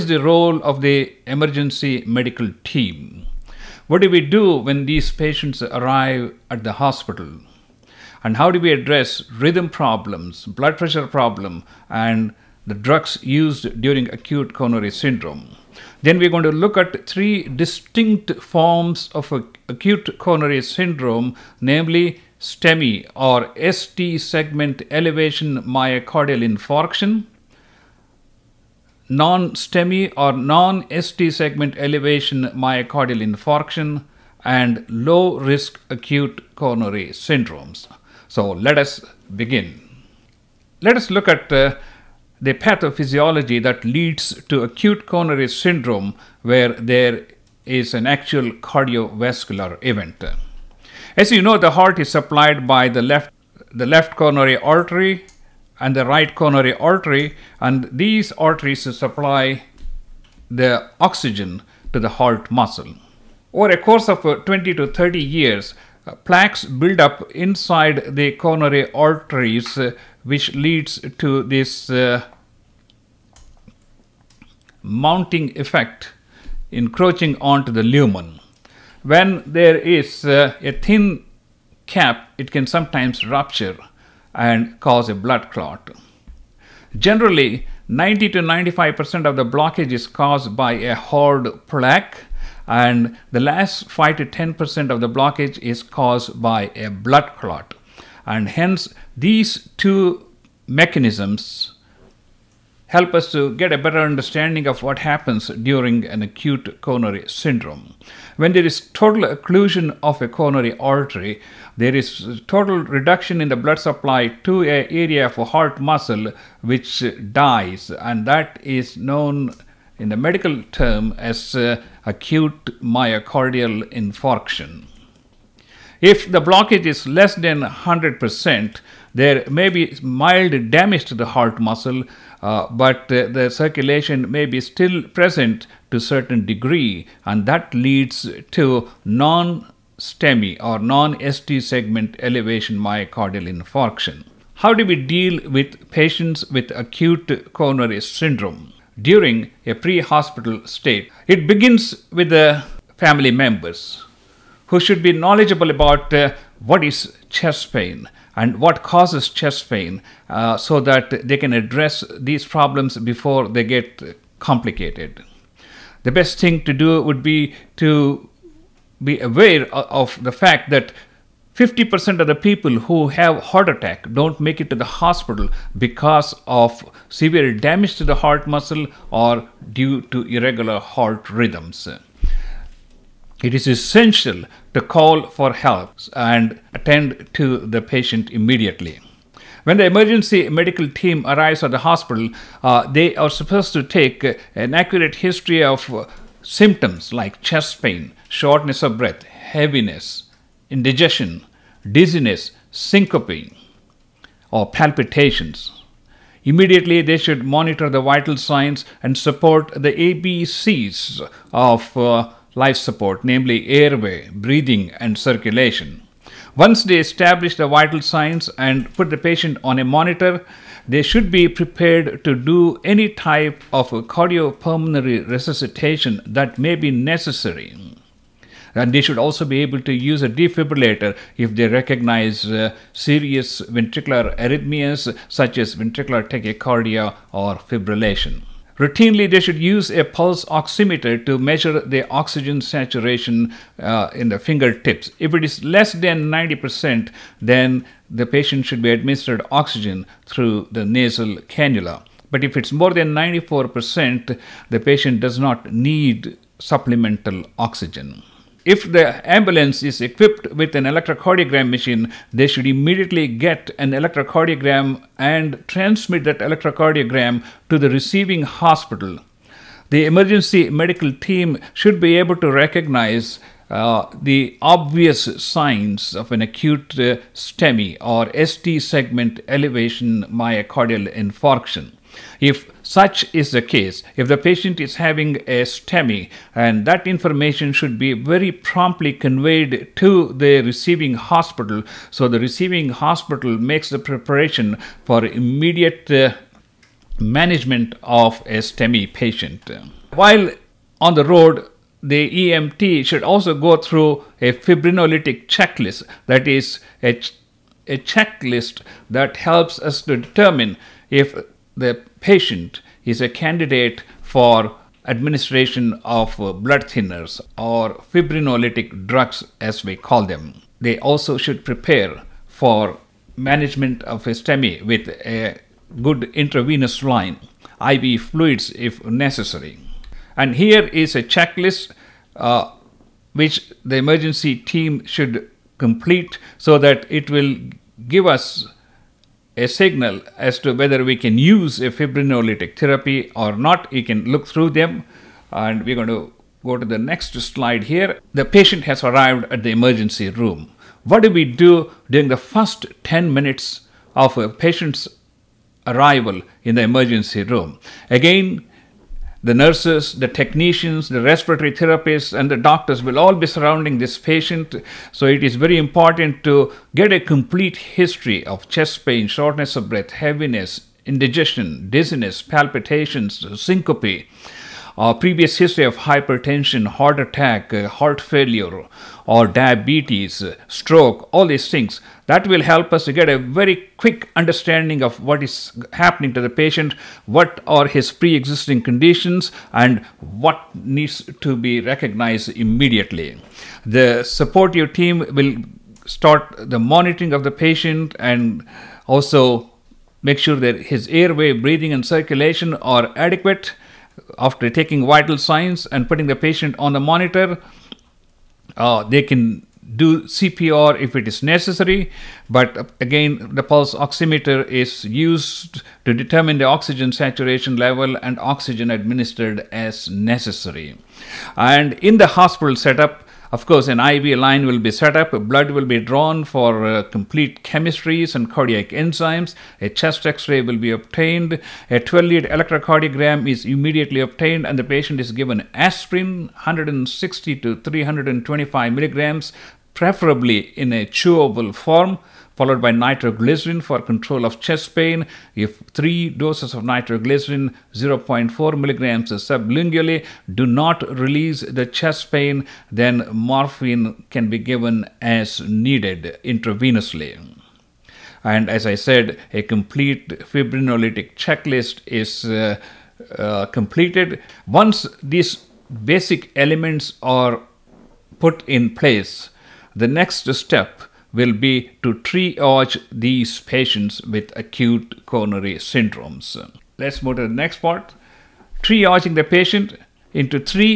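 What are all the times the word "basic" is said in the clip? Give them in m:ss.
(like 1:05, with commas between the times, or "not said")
7:46.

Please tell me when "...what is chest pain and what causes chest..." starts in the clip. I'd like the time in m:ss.
2:36.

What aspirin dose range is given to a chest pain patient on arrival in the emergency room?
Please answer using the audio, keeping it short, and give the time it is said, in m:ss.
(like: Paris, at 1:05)
160 to 325 milligrams, at 7:16.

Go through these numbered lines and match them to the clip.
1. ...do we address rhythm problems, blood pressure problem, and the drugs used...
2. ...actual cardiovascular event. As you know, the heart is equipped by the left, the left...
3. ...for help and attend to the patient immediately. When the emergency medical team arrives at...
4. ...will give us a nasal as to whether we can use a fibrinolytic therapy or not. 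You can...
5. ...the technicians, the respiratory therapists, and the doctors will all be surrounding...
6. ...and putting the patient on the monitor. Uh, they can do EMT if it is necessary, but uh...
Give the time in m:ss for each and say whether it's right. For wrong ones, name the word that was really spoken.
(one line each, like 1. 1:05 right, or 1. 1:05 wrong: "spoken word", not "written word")
1. 0:08 right
2. 0:48 wrong: "supplied", not "equipped"
3. 3:05 right
4. 5:37 wrong: "signal", not "nasal"
5. 6:00 right
6. 6:45 wrong: "CPR", not "EMT".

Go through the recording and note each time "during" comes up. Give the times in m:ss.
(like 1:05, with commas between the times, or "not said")
0:13, 1:45, 2:29, 5:52.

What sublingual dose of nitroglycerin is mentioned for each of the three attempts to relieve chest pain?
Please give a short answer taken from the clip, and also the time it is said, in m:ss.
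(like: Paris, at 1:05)
0.4 milligrams, at 7:27.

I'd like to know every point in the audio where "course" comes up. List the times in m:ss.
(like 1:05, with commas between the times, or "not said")
1:03, 7:03.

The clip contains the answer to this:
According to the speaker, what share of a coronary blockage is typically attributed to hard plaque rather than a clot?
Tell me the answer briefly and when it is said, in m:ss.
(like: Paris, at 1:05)
90 to 95%, at 1:27.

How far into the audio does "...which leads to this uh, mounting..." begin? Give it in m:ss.
1:10.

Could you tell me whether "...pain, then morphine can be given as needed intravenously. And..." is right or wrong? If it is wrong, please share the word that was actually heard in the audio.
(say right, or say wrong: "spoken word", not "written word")
right.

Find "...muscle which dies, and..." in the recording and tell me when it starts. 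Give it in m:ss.
1:55.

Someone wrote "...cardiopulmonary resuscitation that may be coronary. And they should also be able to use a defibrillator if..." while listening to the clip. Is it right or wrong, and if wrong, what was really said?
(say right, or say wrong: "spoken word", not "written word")
wrong: "necessary", not "coronary".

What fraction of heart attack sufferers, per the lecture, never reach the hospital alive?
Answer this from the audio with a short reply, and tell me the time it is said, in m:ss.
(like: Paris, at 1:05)
50%, at 2:51.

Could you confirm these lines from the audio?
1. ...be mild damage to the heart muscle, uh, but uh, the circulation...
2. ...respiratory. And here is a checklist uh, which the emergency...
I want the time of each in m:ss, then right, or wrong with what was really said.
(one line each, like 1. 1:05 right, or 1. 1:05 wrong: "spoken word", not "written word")
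1. 2:09 right
2. 5:29 wrong: "necessary", not "respiratory".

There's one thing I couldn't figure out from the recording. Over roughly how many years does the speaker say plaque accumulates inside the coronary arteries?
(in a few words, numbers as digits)
20 to 30 years.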